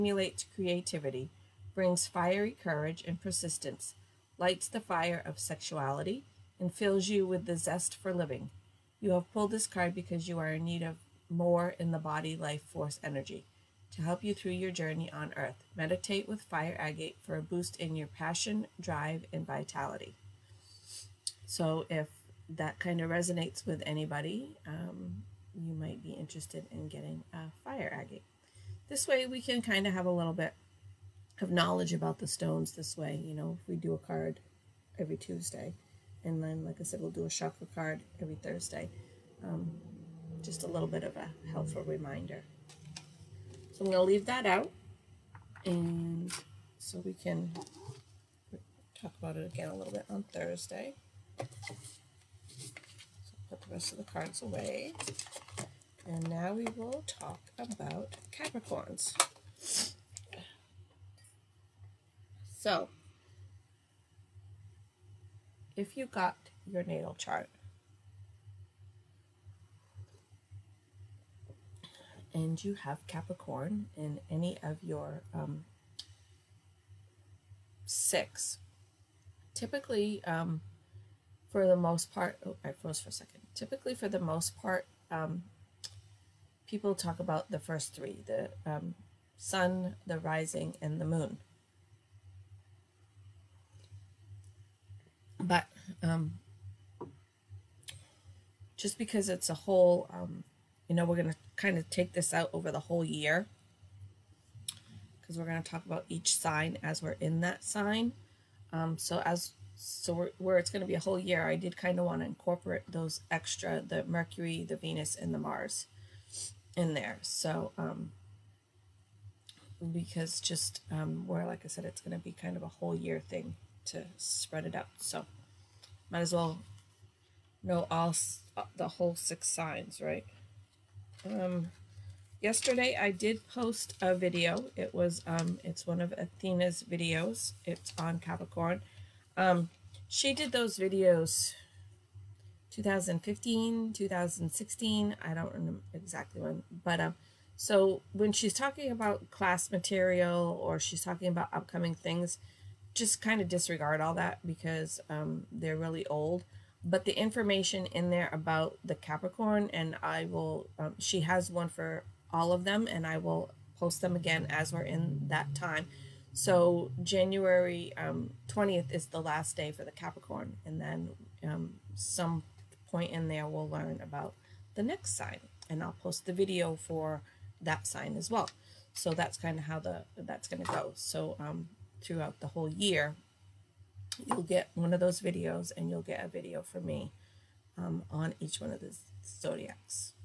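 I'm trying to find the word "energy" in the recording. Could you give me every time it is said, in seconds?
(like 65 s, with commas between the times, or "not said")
13 s.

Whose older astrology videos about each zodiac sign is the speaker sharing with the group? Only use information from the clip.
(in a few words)
Athena.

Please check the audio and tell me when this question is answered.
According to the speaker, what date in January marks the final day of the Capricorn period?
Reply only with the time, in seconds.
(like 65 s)
167 s.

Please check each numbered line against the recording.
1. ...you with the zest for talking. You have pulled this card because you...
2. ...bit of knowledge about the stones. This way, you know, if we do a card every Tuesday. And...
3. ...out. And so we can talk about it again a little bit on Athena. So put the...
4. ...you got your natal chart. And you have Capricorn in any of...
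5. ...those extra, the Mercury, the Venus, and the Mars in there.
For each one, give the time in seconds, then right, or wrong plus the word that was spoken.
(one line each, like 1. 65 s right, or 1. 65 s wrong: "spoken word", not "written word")
1. 7 s wrong: "living", not "talking"
2. 30 s right
3. 44 s wrong: "Thursday", not "Athena"
4. 65 s right
5. 112 s right.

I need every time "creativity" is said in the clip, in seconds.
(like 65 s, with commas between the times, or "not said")
0 s.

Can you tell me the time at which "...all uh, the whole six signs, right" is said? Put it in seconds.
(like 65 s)
127 s.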